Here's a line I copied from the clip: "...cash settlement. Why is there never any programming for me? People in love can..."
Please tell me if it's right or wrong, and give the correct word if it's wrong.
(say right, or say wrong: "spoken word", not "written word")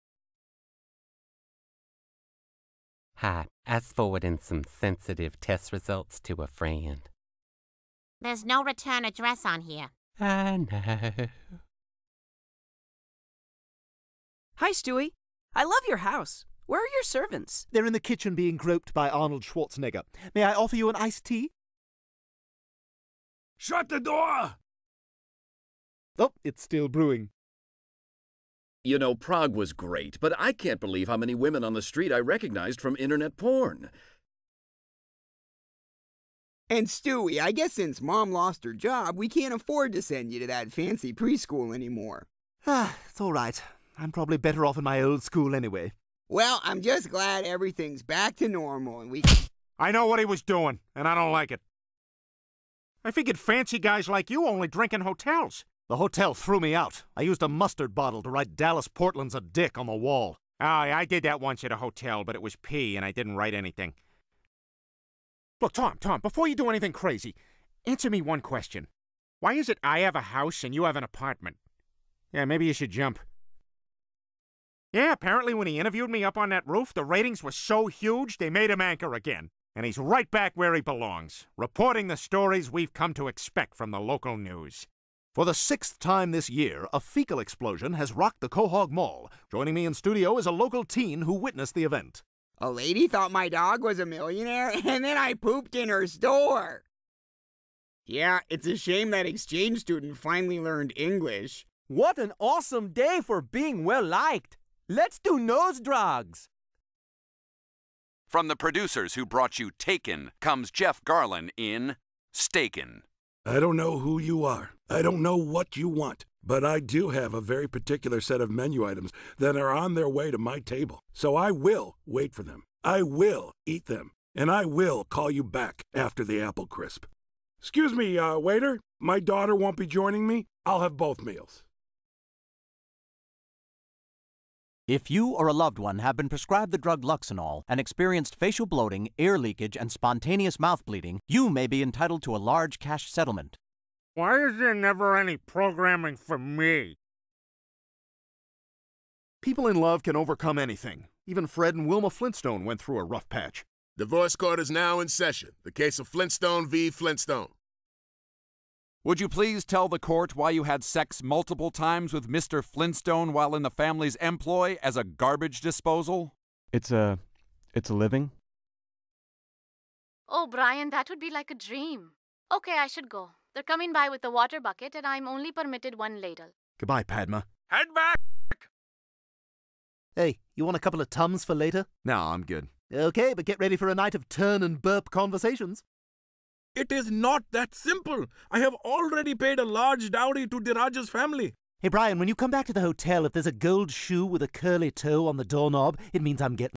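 right.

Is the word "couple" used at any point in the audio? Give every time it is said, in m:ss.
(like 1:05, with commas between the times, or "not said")
3:00.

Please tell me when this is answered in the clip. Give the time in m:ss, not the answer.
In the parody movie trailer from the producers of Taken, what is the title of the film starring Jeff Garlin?
1:52.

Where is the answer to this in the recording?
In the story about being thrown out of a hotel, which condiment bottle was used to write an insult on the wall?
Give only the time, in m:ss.
0:57.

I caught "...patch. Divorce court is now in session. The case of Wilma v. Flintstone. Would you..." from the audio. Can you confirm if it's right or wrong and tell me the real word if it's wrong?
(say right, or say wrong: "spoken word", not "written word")
wrong: "Flintstone", not "Wilma".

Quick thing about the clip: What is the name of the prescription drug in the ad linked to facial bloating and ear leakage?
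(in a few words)
Luxonol.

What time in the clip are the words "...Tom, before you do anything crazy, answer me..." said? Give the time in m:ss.
1:05.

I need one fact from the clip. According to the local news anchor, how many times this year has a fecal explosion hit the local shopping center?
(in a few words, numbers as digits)
6.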